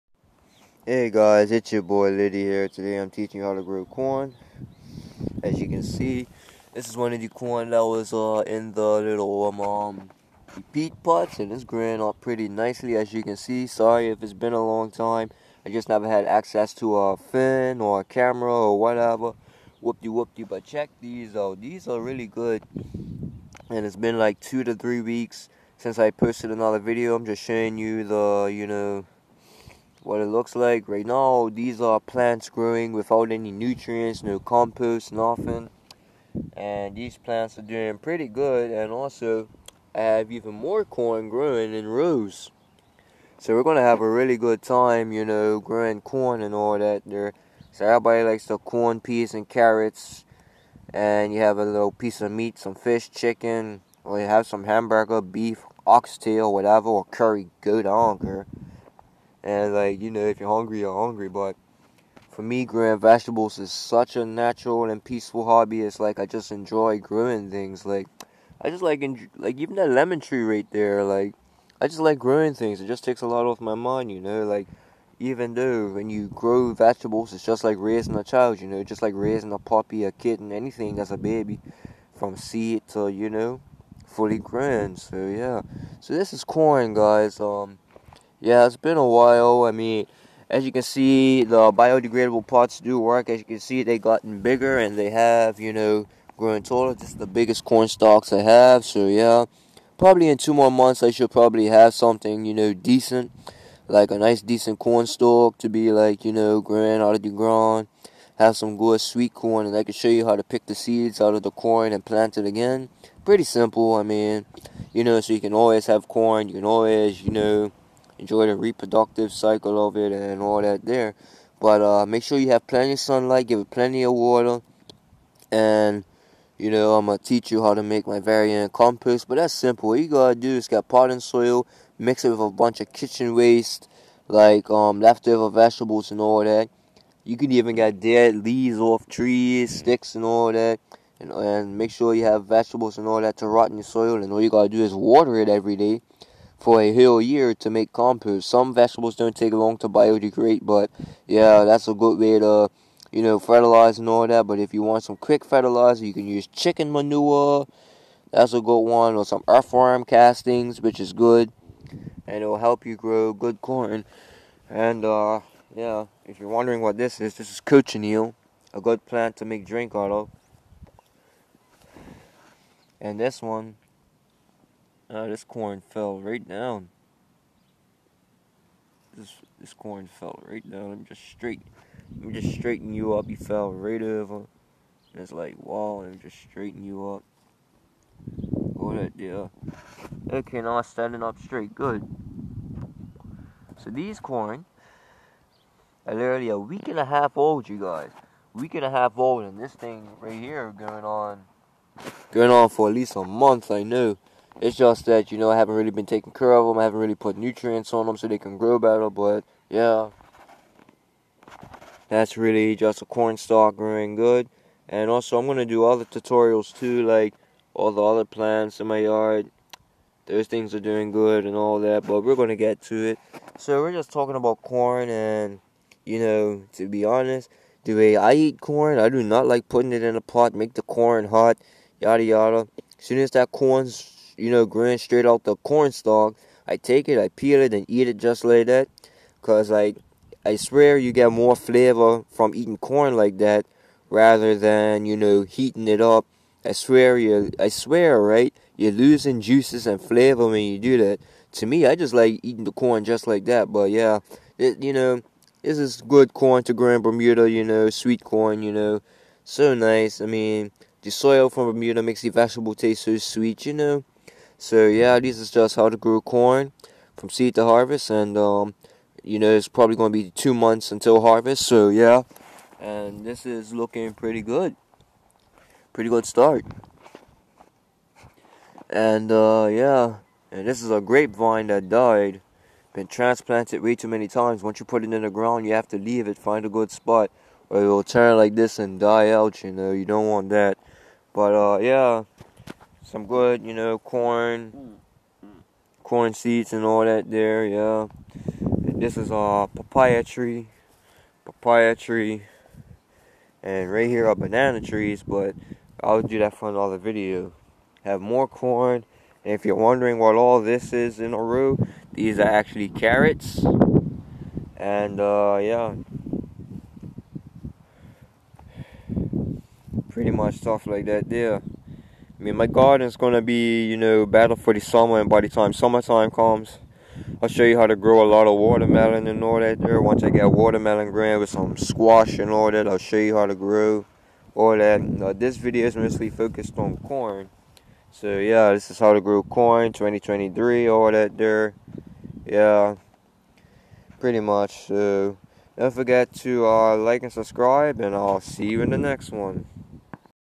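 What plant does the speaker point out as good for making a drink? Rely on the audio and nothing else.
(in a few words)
Cochineal.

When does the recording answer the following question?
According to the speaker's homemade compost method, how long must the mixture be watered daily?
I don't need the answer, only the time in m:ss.
2:26.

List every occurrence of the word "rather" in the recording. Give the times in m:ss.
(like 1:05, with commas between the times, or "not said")
4:04.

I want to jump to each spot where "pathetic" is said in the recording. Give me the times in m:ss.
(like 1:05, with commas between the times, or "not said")
not said.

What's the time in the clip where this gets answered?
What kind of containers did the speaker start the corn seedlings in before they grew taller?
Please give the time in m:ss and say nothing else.
0:10.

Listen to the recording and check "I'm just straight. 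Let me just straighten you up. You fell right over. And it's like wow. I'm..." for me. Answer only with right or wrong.
right.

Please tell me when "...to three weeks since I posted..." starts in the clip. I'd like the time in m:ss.
0:24.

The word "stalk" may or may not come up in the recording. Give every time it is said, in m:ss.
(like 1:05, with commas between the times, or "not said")
1:37, 1:45, 3:33, 3:55.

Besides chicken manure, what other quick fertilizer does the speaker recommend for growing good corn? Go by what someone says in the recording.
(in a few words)
Earthworm castings.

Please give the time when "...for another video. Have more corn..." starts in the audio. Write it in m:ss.
5:06.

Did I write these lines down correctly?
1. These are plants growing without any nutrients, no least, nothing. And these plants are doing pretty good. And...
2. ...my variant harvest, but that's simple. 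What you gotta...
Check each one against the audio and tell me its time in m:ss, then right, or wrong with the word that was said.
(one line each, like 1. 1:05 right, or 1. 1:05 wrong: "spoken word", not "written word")
1. 0:31 wrong: "compost", not "least"
2. 2:08 wrong: "compost", not "harvest".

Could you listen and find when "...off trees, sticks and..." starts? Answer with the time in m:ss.
2:18.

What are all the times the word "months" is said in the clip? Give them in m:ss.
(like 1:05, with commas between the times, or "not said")
1:40, 3:23, 4:30.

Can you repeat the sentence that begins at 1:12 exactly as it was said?
It just takes a lot off my mind.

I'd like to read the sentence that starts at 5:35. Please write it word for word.
Now, this video is mostly focused on corn.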